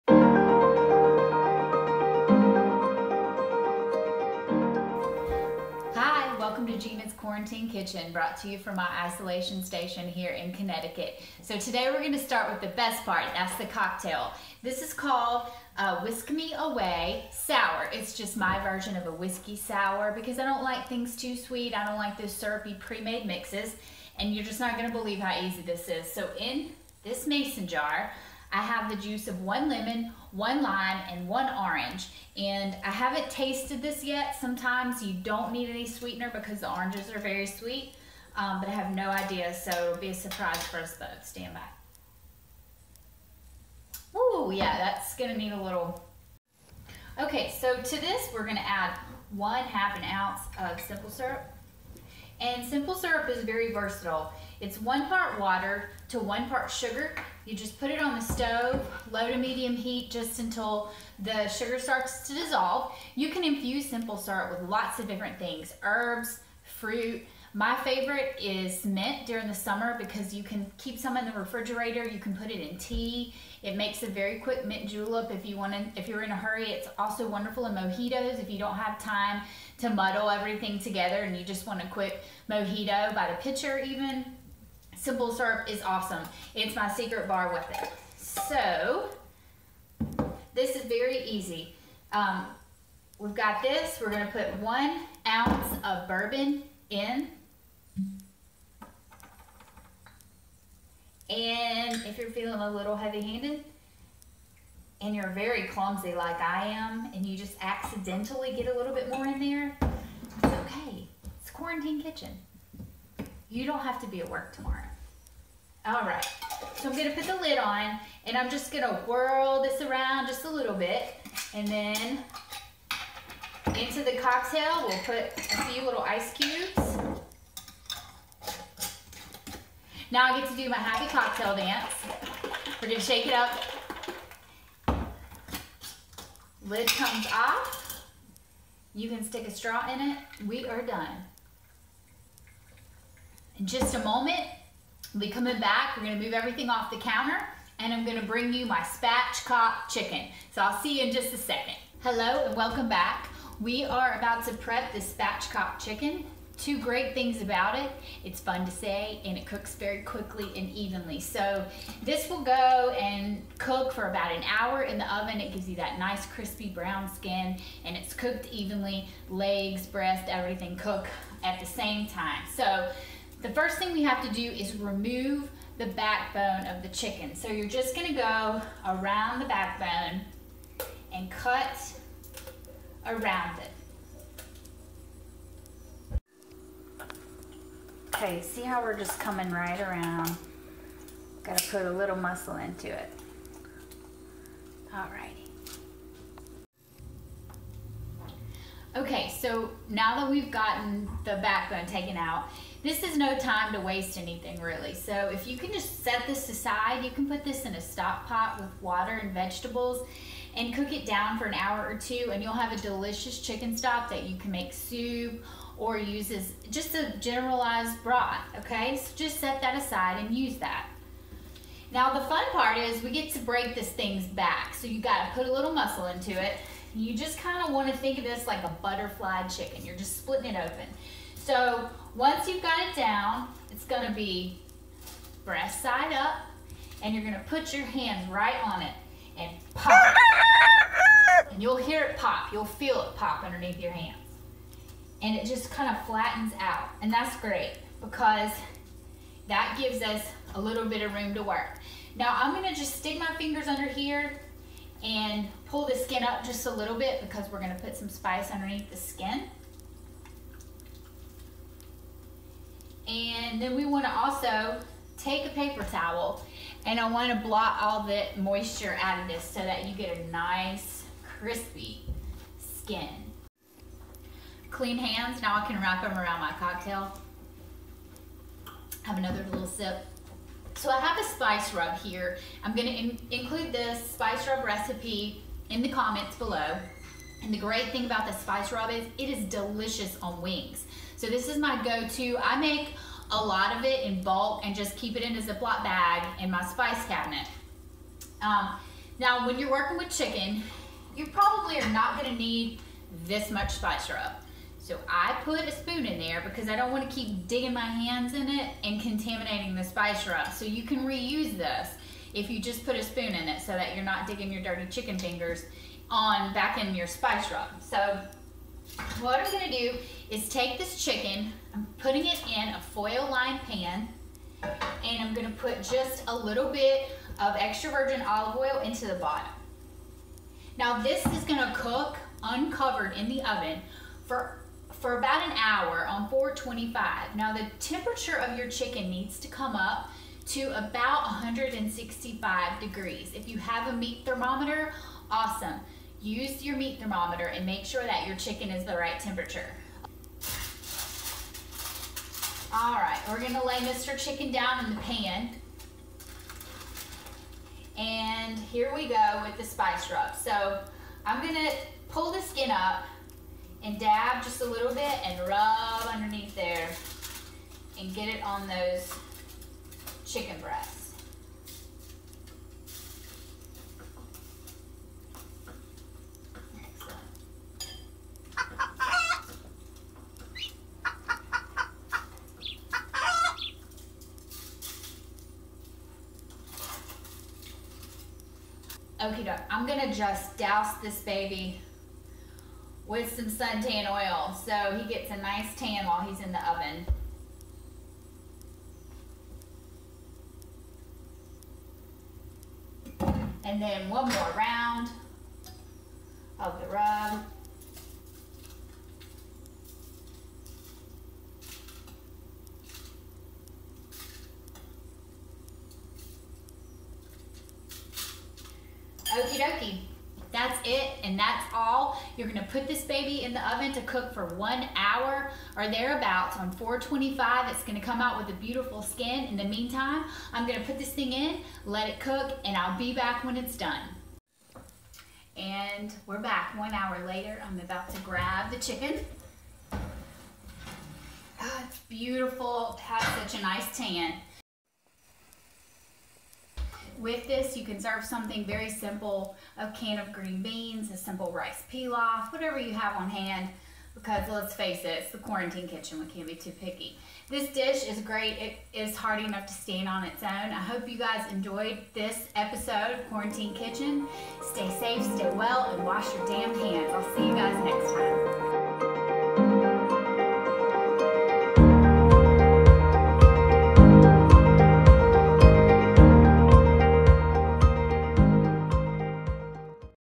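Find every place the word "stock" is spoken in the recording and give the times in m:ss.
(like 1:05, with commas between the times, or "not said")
3:27, 3:33.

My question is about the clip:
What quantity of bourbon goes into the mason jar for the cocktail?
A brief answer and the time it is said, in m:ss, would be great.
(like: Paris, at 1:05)
1 ounce, at 1:34.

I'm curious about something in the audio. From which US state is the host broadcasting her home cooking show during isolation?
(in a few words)
Connecticut.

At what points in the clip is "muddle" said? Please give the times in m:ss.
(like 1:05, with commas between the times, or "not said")
1:19.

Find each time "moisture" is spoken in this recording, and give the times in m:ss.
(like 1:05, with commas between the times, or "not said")
4:28.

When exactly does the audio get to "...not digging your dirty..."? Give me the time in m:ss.
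5:14.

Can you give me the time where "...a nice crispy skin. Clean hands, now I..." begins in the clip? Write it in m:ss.
4:30.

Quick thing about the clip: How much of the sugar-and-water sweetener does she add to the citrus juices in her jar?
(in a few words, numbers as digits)
Half an ounce.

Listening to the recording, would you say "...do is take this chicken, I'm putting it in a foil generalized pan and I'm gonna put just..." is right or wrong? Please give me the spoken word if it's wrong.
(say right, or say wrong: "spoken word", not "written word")
wrong: "lined", not "generalized".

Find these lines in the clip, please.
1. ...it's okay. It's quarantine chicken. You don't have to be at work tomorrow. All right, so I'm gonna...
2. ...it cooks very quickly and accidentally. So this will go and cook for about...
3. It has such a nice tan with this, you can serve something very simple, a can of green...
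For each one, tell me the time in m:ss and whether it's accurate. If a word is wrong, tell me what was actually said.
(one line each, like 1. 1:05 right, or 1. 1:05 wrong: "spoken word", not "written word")
1. 1:49 wrong: "kitchen", not "chicken"
2. 2:39 wrong: "evenly", not "accidentally"
3. 7:22 right.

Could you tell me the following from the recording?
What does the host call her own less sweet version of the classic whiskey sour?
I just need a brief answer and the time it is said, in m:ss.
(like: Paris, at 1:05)
Whisk Me Away Sour, at 0:16.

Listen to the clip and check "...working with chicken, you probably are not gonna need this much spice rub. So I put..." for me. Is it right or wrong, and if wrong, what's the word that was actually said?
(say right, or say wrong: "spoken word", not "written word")
right.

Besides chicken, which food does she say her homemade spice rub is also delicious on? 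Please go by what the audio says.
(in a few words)
Wings.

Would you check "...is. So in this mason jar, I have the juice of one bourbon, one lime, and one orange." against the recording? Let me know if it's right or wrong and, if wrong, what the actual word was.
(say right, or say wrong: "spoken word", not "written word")
wrong: "lemon", not "bourbon".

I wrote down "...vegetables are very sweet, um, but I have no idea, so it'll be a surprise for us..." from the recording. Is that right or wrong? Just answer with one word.
wrong.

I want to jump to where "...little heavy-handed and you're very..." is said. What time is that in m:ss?
1:42.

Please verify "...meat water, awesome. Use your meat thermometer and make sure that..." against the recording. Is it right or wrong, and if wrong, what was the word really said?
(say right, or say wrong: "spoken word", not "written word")
wrong: "thermometer", not "water".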